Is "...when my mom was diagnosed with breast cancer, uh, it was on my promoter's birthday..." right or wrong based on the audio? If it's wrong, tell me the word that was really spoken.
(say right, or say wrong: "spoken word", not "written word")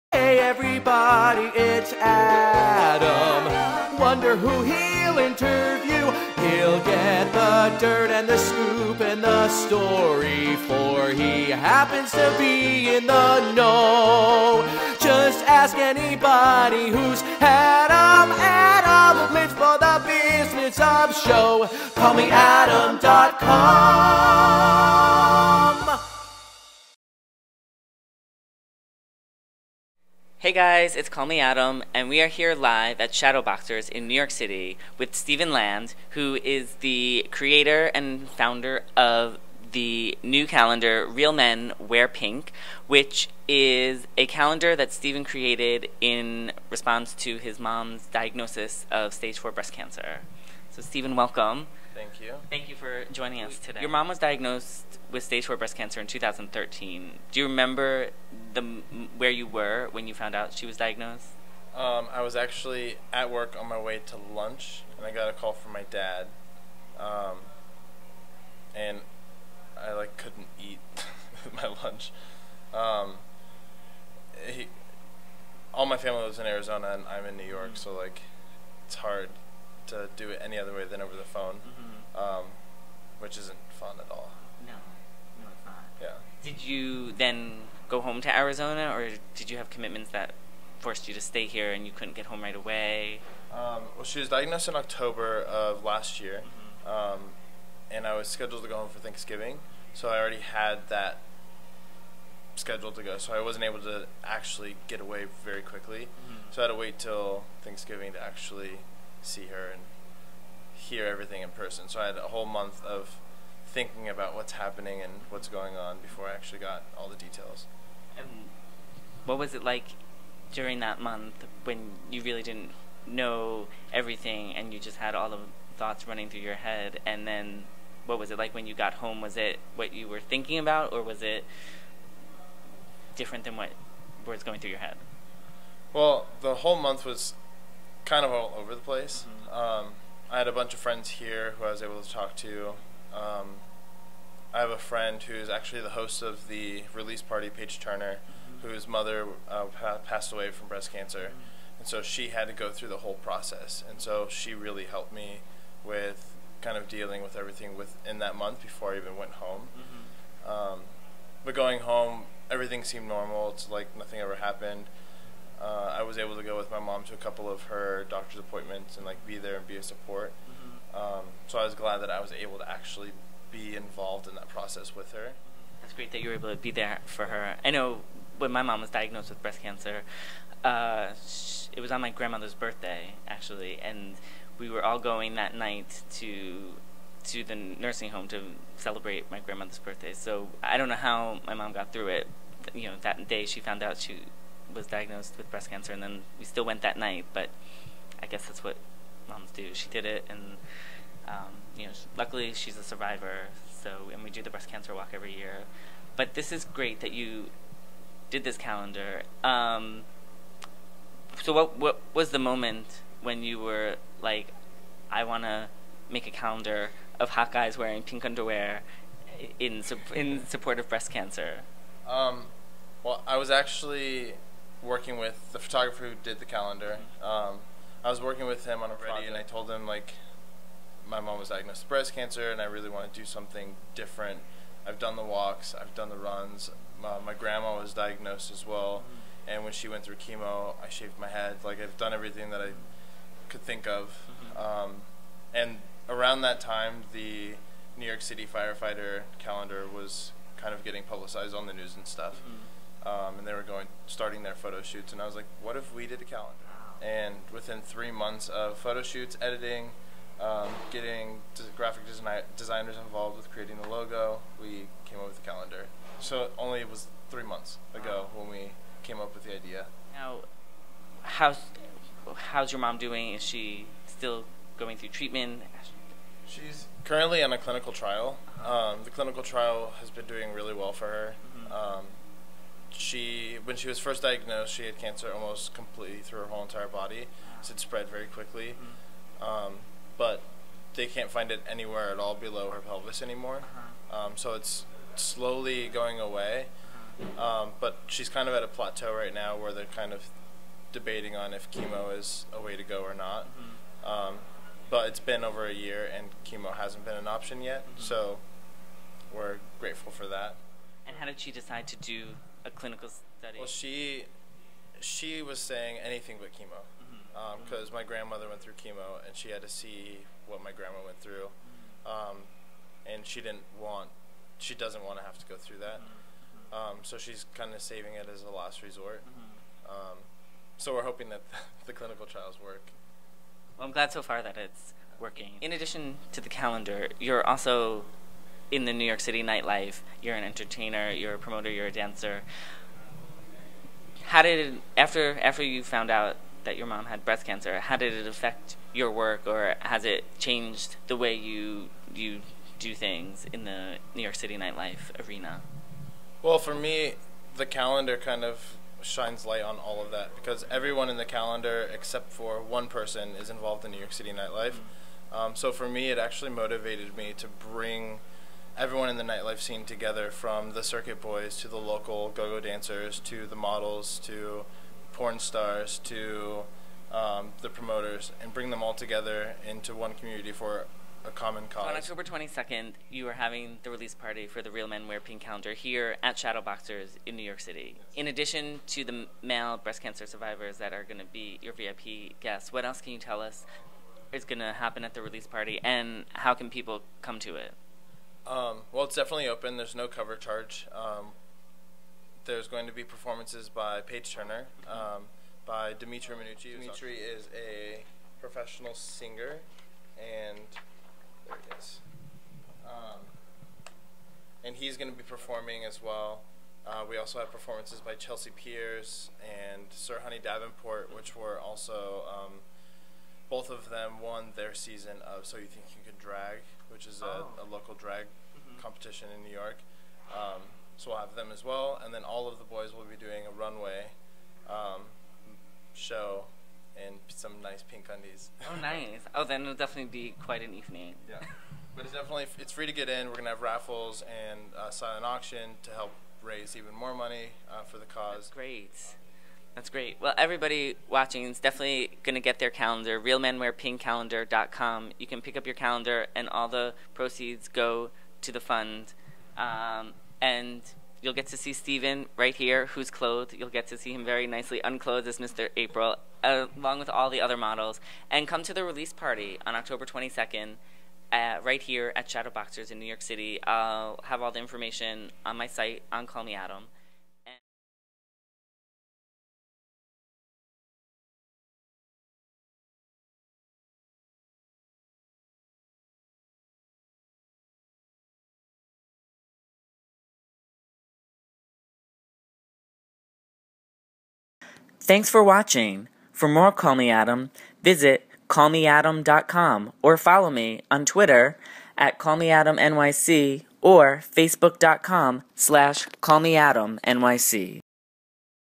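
wrong: "grandmother", not "promoter".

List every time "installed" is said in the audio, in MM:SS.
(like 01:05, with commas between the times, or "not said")
not said.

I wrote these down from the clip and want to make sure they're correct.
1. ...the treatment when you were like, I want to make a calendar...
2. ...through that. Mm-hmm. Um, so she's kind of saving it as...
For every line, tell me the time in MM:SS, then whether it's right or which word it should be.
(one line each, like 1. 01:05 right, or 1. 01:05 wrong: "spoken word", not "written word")
1. 03:32 wrong: "moment", not "treatment"
2. 05:25 right.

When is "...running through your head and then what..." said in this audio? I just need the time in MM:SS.
02:06.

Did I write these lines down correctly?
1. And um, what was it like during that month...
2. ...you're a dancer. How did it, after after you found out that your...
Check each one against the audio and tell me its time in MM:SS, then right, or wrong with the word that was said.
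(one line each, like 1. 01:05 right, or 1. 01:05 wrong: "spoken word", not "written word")
1. 01:58 right
2. 05:41 right.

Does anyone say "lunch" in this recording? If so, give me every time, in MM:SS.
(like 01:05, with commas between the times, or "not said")
01:04, 01:11.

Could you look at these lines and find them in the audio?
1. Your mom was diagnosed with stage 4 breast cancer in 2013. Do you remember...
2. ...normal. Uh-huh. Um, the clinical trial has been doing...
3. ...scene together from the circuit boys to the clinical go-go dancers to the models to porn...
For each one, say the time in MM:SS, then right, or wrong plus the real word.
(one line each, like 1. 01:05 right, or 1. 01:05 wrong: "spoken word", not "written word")
1. 00:53 right
2. 04:37 wrong: "trial", not "normal"
3. 06:09 wrong: "local", not "clinical".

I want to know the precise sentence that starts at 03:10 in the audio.
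So I don't know how my mom got through it.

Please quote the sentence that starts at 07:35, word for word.
You can pick up your calendar, and all the proceeds go to the fund.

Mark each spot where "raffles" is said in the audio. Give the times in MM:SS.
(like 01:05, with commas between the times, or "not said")
07:23.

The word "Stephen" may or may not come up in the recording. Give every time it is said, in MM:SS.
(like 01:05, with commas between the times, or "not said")
00:35, 00:44, 00:50, 07:41.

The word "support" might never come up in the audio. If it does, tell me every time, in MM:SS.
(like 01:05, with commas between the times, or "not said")
02:49, 03:40.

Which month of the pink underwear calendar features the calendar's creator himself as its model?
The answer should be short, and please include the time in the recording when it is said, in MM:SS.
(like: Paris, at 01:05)
April, at 07:45.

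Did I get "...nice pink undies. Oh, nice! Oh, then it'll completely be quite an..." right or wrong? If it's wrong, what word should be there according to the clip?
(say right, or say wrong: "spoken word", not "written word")
wrong: "definitely", not "completely".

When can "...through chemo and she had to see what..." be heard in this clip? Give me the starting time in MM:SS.
05:18.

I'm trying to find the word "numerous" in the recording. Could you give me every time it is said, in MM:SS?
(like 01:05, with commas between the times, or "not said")
not said.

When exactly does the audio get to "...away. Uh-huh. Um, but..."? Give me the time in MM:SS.
04:56.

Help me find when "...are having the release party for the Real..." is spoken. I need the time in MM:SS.
06:23.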